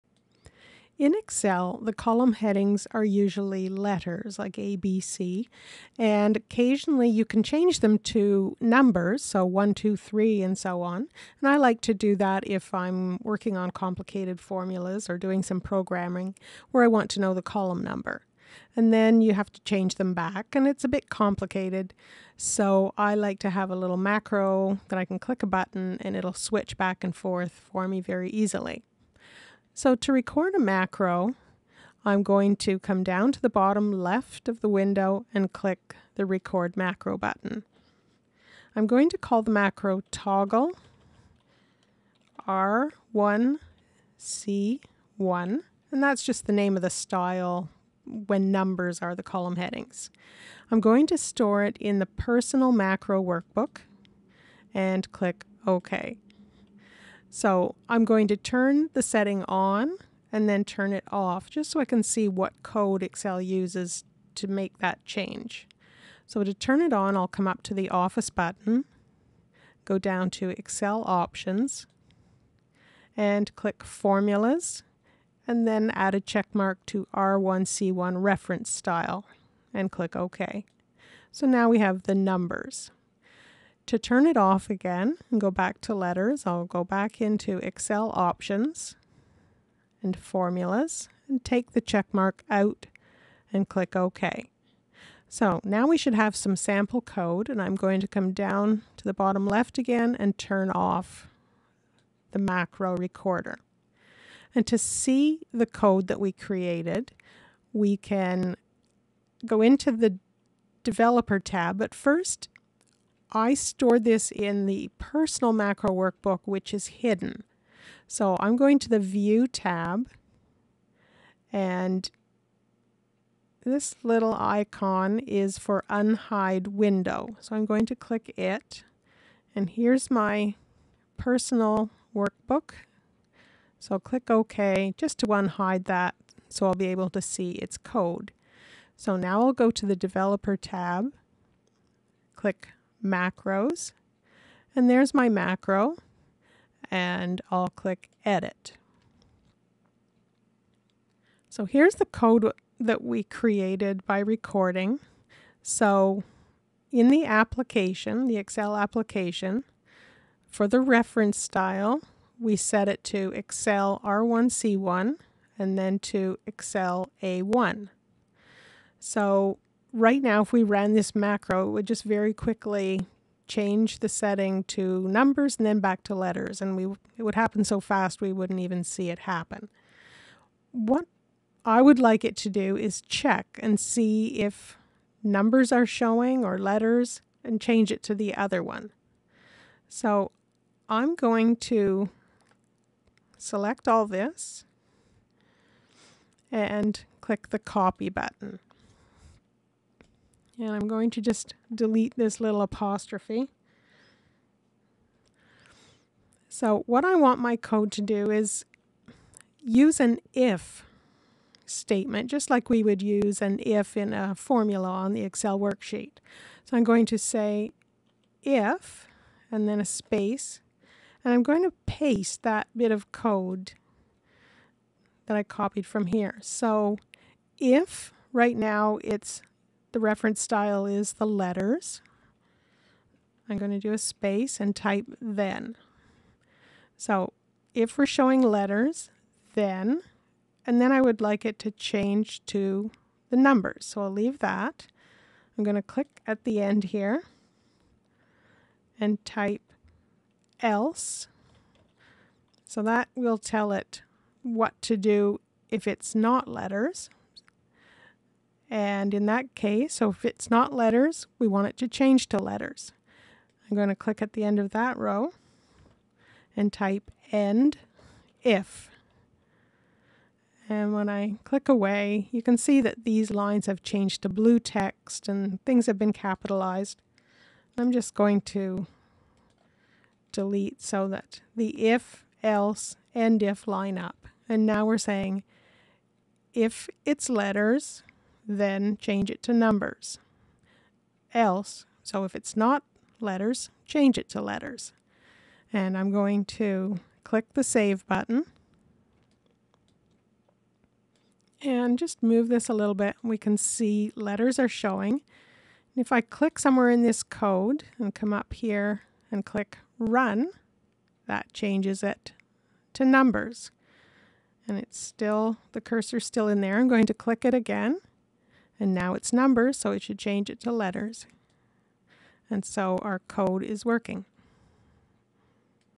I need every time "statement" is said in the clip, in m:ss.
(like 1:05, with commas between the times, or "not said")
3:31.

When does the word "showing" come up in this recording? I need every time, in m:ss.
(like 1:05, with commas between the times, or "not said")
3:05, 3:58, 5:04.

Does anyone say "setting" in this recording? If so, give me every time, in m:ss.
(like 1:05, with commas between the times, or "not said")
0:59, 2:54.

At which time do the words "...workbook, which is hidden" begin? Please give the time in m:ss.
1:55.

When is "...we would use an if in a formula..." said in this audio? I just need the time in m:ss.
3:32.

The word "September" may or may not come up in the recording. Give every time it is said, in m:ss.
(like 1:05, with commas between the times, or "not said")
not said.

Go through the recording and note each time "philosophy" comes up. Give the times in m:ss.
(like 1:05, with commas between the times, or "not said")
not said.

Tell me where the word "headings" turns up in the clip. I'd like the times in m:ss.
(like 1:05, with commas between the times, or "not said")
0:02, 0:49.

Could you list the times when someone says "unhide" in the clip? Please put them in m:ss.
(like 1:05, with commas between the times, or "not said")
2:05, 2:15.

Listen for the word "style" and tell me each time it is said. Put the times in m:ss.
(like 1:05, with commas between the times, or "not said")
0:46, 1:18, 2:41, 3:50.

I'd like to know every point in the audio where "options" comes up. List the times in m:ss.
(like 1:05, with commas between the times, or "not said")
1:11, 1:28.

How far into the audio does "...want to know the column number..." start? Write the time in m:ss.
0:16.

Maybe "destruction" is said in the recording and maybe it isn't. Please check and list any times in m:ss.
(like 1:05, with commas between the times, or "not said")
not said.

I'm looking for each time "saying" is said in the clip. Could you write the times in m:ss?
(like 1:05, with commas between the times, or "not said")
4:44.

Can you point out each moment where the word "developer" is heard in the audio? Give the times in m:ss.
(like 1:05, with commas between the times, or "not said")
1:50, 2:19.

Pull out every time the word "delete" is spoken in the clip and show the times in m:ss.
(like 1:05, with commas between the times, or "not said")
3:21, 4:40.